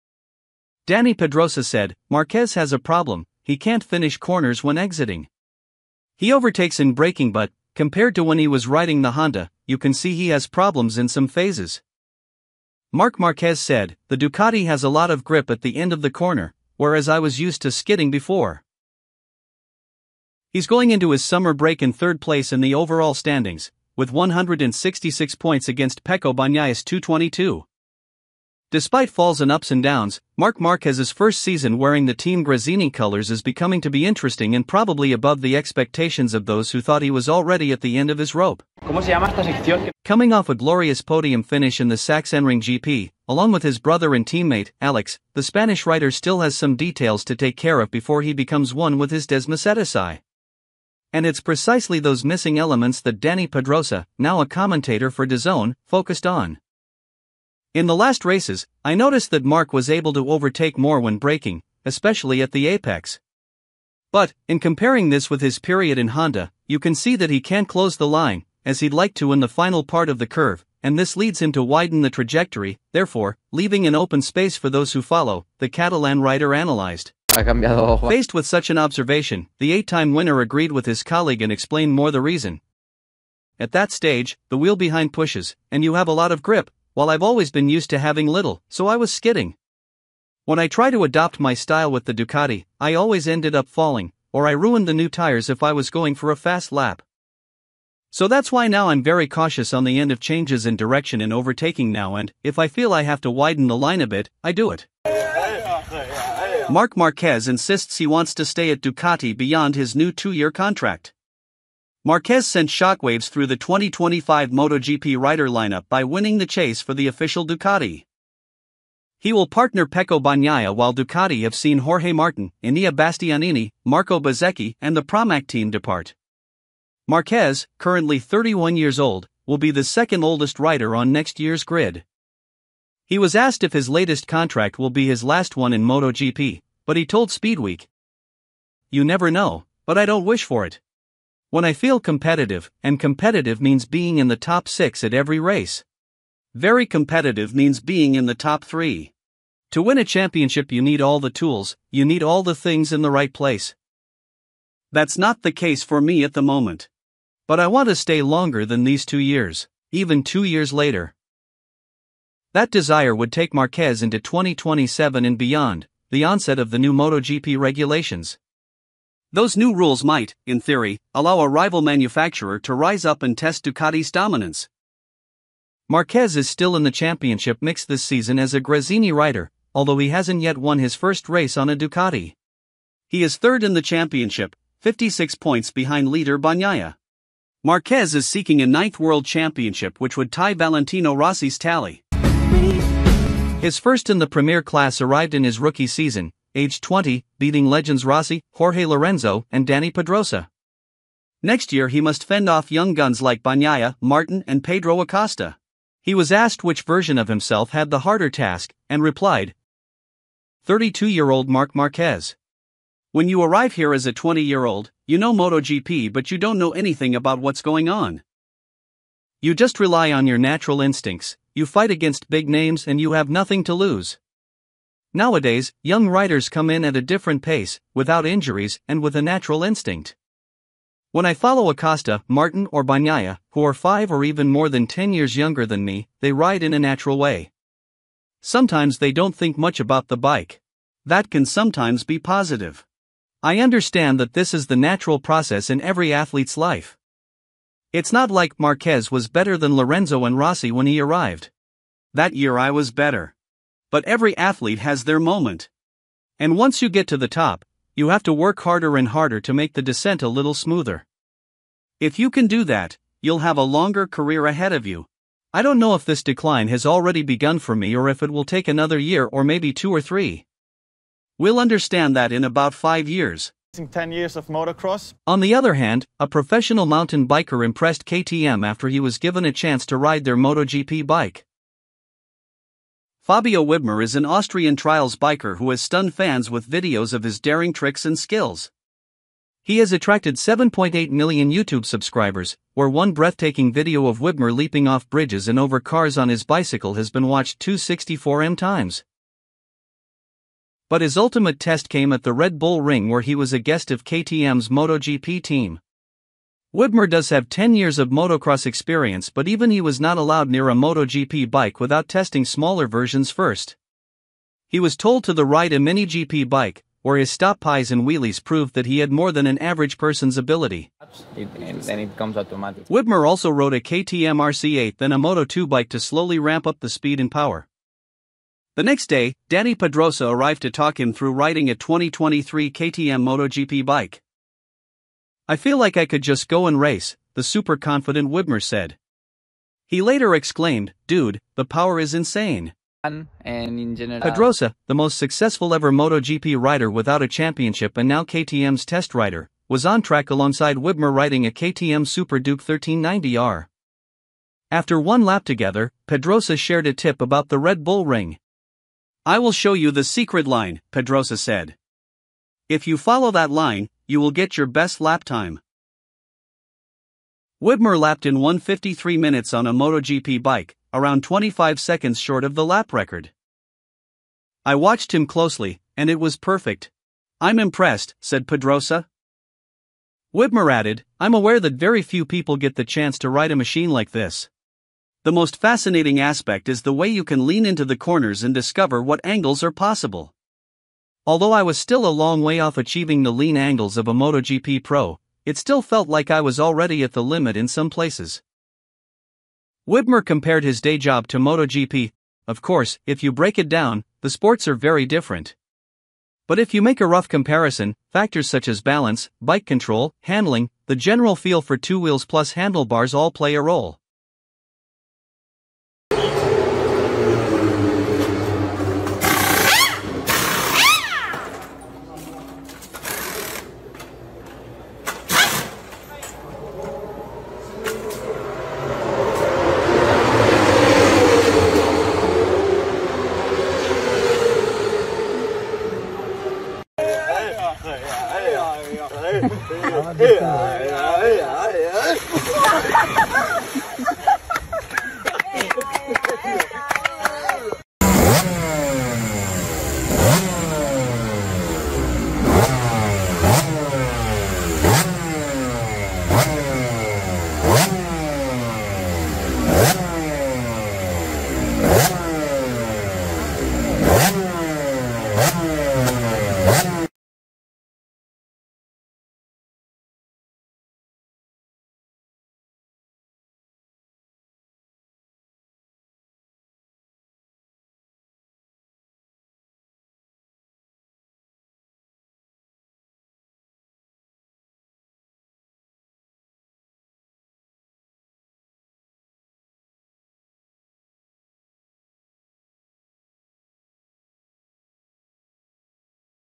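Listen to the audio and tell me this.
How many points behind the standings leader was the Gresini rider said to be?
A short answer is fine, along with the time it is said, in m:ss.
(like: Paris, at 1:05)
56, at 3:04.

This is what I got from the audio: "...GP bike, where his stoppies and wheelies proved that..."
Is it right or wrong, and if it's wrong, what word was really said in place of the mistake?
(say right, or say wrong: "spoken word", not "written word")
right.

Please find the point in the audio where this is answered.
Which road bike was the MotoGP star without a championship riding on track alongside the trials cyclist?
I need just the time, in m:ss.
5:51.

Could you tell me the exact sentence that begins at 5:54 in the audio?
After one lap together, Pedrosa shared a tip about the Red Bull ring.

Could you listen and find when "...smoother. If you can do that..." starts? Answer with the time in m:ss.
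4:20.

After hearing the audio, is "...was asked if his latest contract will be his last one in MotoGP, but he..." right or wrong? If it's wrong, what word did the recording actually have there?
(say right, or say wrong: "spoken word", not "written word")
right.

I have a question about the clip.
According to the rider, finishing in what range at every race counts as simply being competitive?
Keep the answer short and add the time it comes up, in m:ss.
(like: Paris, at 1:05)
top 6, at 2:24.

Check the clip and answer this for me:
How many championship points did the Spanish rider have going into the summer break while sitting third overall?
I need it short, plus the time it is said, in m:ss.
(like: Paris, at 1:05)
166, at 0:24.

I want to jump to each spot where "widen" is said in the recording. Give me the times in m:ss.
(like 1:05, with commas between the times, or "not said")
1:11, 1:43.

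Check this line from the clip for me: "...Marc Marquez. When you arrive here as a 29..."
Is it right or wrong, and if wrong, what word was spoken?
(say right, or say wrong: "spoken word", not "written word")
wrong: "20", not "29".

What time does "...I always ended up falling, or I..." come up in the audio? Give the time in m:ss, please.
1:32.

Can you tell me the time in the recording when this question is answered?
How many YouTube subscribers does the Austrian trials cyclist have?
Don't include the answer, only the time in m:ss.
4:50.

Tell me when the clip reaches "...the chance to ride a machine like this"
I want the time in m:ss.
6:22.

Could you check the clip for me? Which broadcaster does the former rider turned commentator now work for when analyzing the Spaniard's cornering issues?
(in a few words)
DAZN.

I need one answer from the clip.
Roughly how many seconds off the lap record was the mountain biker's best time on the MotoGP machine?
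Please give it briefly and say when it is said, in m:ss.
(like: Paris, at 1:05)
25, at 6:11.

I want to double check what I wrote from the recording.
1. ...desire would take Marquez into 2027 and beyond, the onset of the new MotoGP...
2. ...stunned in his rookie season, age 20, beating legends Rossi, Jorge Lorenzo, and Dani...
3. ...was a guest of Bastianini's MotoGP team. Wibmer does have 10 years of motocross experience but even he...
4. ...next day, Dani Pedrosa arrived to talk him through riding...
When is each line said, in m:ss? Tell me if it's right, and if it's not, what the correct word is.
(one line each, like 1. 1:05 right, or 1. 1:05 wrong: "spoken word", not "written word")
1. 2:42 right
2. 3:14 wrong: "arrived", not "stunned"
3. 5:03 wrong: "KTM", not "Bastianini"
4. 5:28 right.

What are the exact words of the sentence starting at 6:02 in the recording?
If you follow that line, you will get your best lap time.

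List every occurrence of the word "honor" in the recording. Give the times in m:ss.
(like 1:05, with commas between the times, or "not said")
not said.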